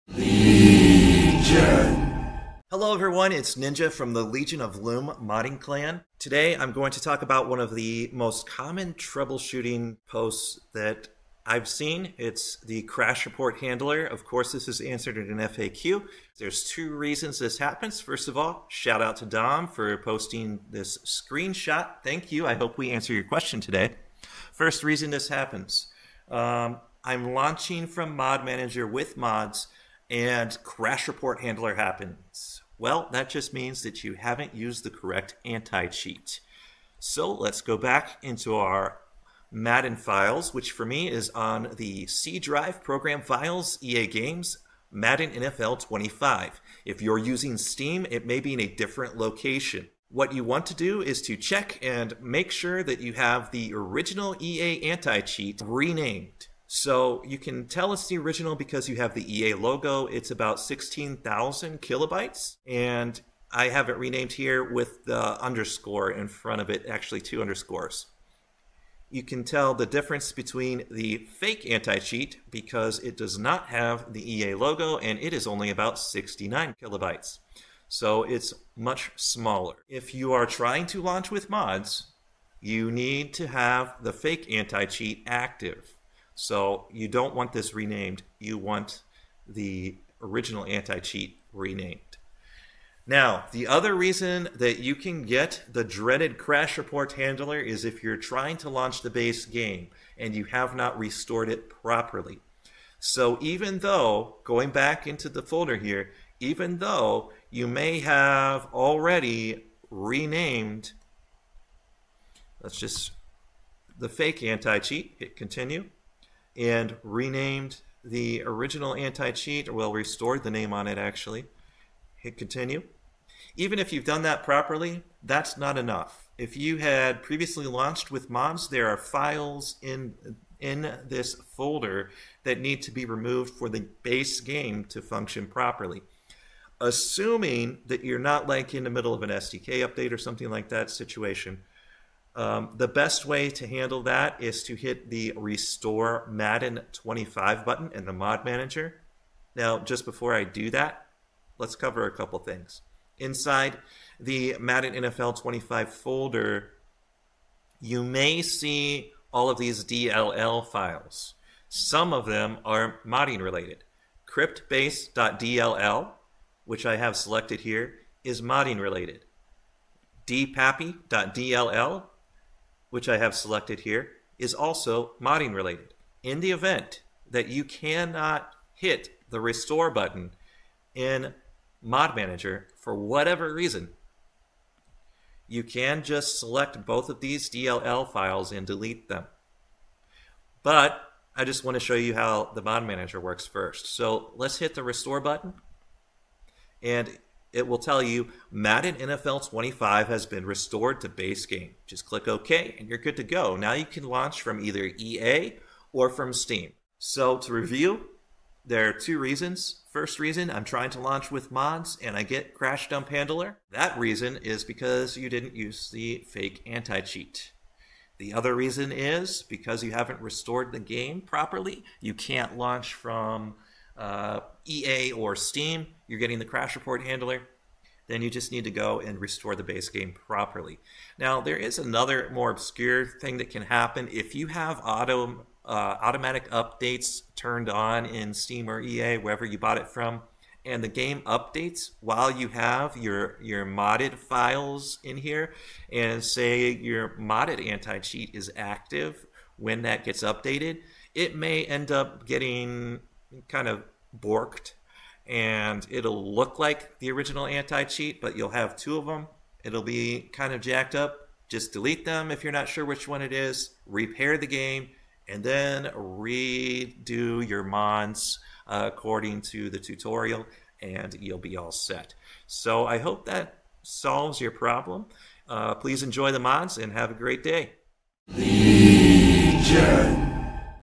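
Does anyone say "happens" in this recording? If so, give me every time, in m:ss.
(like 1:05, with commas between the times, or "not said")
0:17, 0:25, 0:31, 3:53.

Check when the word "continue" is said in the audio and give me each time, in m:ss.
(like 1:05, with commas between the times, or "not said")
1:55, 2:02.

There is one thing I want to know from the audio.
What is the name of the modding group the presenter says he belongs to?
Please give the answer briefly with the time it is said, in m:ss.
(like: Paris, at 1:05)
Legion of Loom, at 0:04.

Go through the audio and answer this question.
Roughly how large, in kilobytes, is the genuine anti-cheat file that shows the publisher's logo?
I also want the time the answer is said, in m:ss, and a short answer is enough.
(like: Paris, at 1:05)
16,000 kilobytes, at 1:00.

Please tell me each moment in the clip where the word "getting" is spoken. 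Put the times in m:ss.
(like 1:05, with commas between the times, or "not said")
3:46, 4:12.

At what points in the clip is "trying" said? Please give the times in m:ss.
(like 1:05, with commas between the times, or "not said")
1:20, 1:38, 3:30.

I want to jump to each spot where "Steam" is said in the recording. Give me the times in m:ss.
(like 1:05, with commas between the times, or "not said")
0:47, 3:26, 3:45, 3:58.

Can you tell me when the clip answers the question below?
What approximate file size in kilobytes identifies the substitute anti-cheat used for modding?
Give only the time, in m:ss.
1:15.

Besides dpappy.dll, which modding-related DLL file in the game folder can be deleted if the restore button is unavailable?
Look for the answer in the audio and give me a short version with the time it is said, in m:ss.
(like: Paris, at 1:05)
CryptBase.dll, at 2:44.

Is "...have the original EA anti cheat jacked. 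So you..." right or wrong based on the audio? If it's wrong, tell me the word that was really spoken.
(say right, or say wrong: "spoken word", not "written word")
wrong: "renamed", not "jacked".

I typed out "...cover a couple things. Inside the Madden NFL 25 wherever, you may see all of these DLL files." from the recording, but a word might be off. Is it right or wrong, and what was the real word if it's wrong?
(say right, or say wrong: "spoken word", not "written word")
wrong: "folder", not "wherever".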